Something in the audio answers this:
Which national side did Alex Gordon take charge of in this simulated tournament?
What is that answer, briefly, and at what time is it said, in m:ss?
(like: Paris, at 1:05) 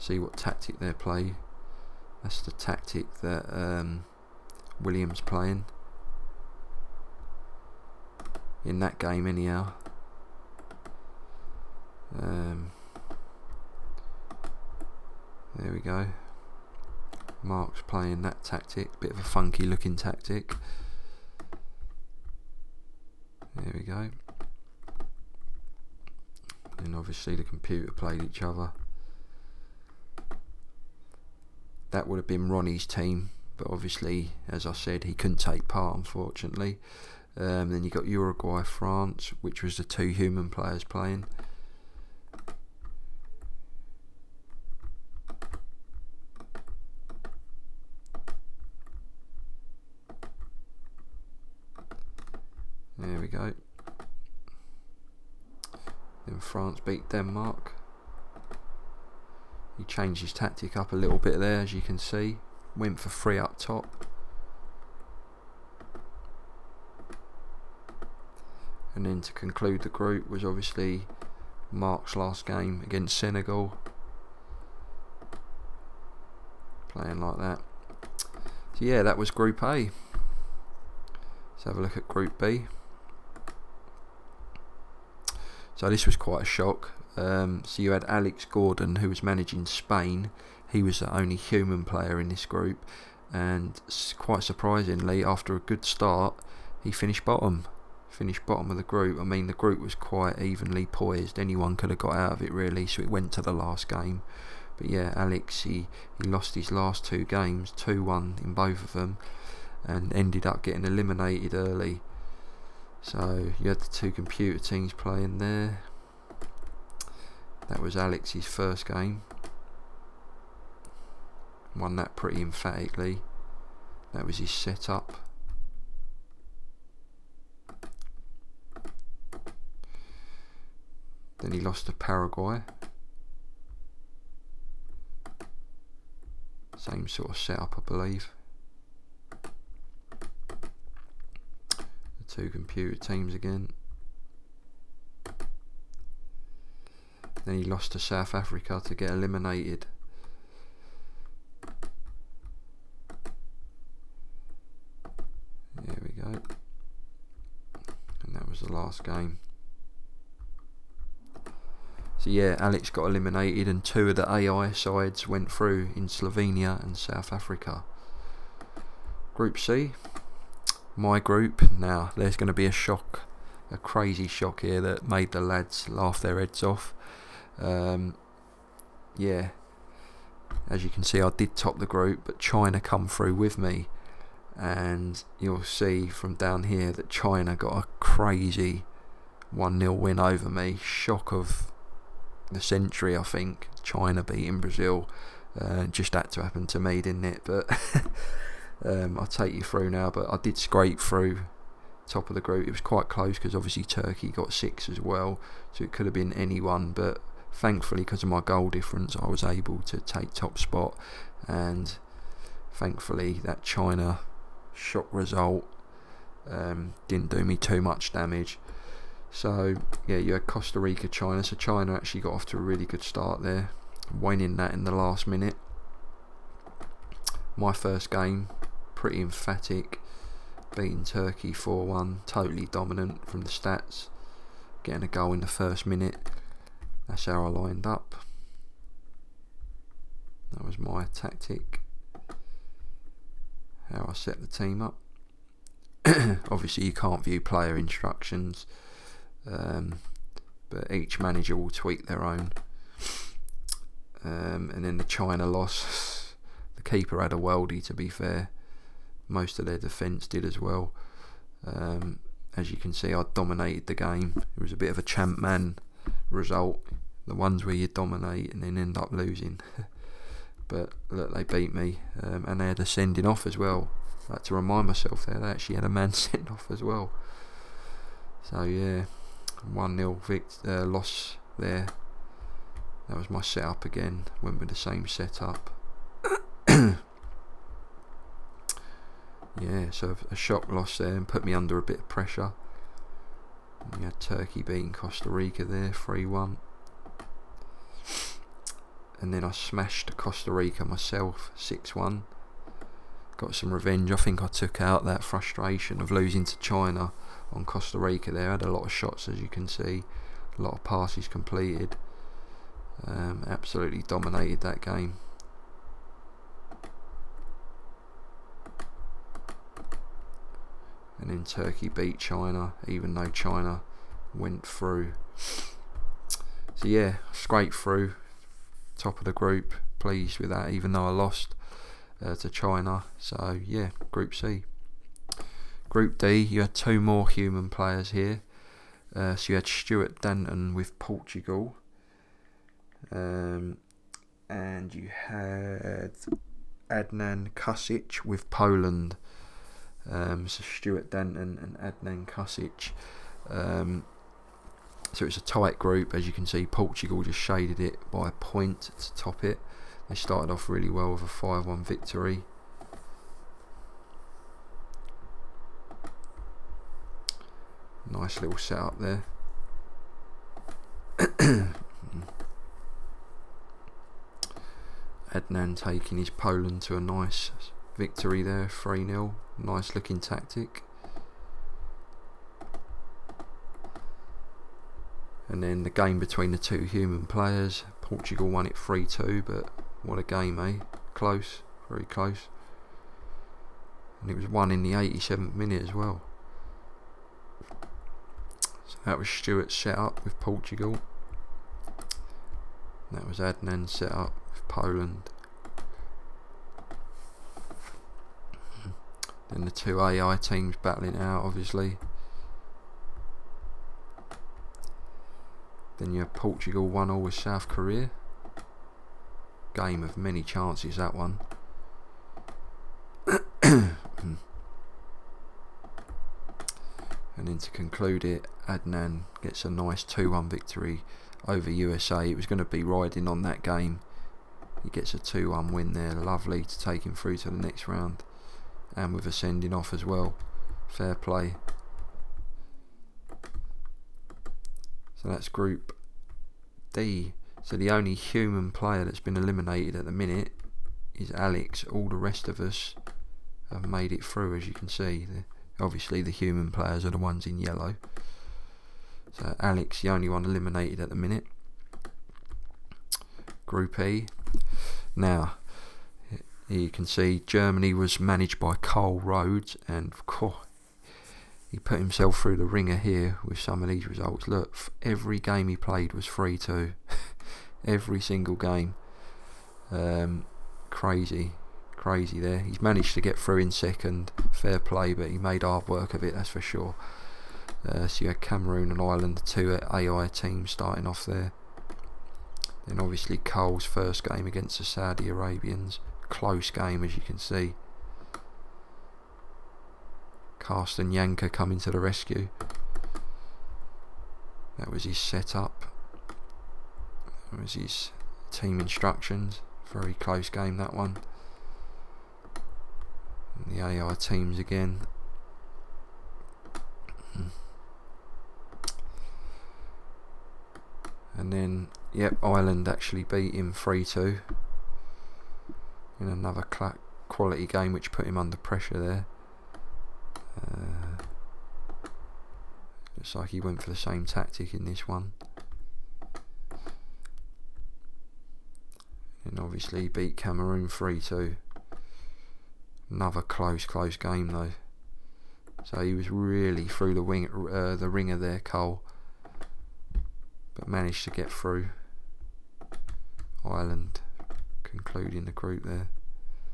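Spain, at 1:29.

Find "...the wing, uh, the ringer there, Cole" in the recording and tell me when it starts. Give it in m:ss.
9:07.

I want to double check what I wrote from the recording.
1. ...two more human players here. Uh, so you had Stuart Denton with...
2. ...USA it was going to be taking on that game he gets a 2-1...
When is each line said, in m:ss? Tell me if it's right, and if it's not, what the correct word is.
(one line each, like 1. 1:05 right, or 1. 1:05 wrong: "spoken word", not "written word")
1. 5:36 right
2. 7:11 wrong: "riding", not "taking".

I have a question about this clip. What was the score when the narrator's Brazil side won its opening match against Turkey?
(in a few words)
4-1.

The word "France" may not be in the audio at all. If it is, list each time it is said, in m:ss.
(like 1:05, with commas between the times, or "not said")
0:38, 0:56.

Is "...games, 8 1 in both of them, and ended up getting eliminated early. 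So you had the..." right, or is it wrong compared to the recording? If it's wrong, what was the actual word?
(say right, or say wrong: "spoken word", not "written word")
wrong: "2", not "8".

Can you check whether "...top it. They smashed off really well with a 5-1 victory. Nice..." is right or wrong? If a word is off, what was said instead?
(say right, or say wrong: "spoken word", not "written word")
wrong: "started", not "smashed".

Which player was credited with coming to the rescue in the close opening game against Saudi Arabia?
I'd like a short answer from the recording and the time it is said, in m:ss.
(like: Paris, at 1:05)
Carsten Jancker, at 8:20.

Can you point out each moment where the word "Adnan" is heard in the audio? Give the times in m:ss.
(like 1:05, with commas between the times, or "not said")
5:46, 5:51, 6:15, 6:43, 7:08.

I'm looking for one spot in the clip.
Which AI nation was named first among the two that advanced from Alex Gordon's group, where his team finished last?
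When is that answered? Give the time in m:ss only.
2:46.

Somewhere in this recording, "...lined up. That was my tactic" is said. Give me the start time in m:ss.
3:57.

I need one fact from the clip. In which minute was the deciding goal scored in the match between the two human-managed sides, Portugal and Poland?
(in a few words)
87th.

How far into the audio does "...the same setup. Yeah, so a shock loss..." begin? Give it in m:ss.
4:44.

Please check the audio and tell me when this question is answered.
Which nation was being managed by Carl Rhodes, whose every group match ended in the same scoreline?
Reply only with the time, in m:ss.
7:47.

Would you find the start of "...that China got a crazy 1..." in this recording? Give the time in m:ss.
3:06.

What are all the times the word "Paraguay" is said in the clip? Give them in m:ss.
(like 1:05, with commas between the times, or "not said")
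2:11.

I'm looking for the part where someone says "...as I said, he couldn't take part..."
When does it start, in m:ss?
0:34.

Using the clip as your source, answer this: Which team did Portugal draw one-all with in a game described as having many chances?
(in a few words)
South Korea.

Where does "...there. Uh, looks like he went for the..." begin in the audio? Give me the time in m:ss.
8:48.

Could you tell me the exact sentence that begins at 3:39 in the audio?
So yeah, you had Costa Rica, China.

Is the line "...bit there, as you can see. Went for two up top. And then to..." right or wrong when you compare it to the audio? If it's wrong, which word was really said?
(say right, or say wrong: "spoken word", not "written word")
wrong: "three", not "two".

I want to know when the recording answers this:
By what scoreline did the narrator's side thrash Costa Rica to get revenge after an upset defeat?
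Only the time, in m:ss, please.
5:01.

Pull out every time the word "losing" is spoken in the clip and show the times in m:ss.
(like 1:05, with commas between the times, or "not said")
4:29, 5:06.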